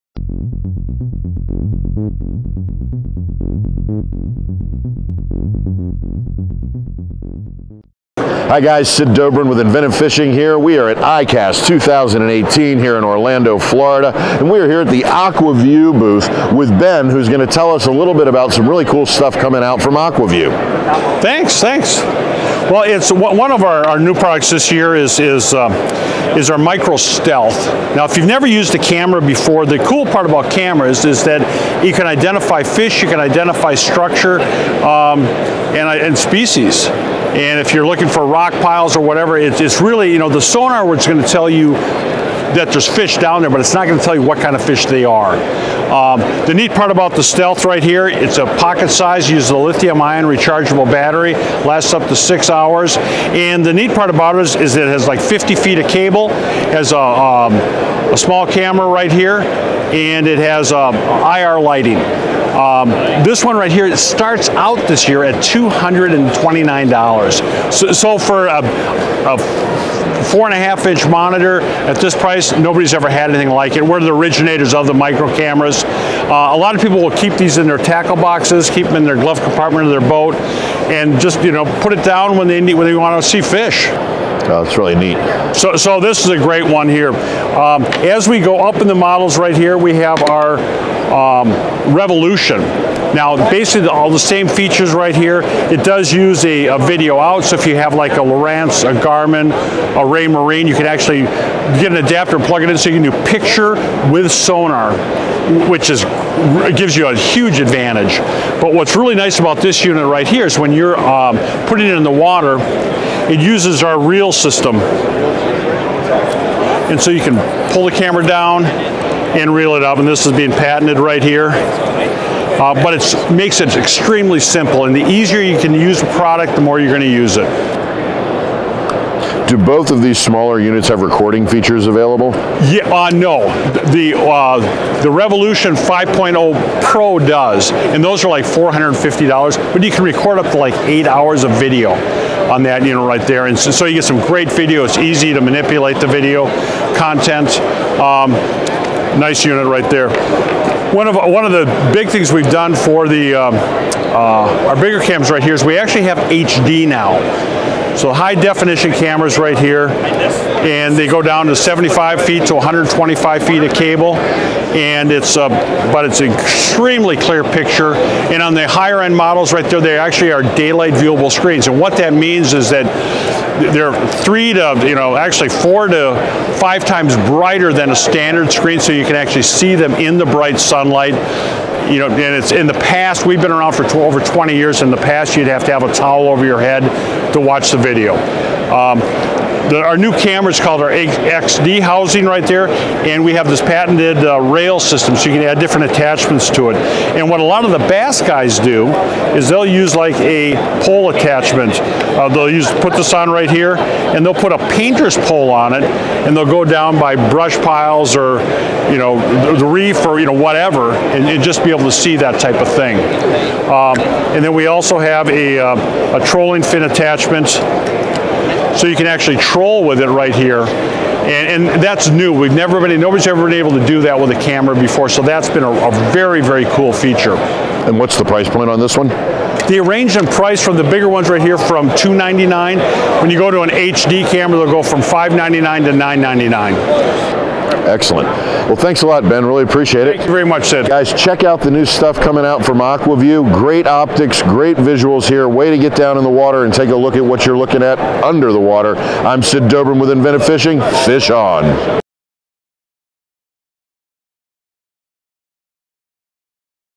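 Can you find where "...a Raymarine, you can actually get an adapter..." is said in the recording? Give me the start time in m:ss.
1:39.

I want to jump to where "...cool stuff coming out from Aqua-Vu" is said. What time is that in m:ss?
0:18.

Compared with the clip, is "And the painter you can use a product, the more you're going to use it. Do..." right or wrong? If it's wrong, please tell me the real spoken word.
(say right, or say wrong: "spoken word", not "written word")
wrong: "easier", not "painter".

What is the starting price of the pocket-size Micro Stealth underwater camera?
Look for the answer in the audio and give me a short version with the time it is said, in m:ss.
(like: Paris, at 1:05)
$229, at 1:05.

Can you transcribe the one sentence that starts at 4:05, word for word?
Way to get down in the water and take a look at what you're looking at under the water.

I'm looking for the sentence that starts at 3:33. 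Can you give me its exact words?
Um, and then we also have a, uh, a trolling fin attachment so you can actually troll with it right here.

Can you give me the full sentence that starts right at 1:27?
Um, as we go up in the models right here, we have our um, Revolution.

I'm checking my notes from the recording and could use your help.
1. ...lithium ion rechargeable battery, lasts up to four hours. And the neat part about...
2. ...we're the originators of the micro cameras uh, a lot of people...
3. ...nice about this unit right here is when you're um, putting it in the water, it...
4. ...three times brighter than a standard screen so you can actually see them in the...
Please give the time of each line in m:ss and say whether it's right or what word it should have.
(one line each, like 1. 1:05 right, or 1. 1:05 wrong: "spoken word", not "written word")
1. 0:49 wrong: "six", not "four"
2. 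1:13 right
3. 1:49 right
4. 2:56 wrong: "five", not "three".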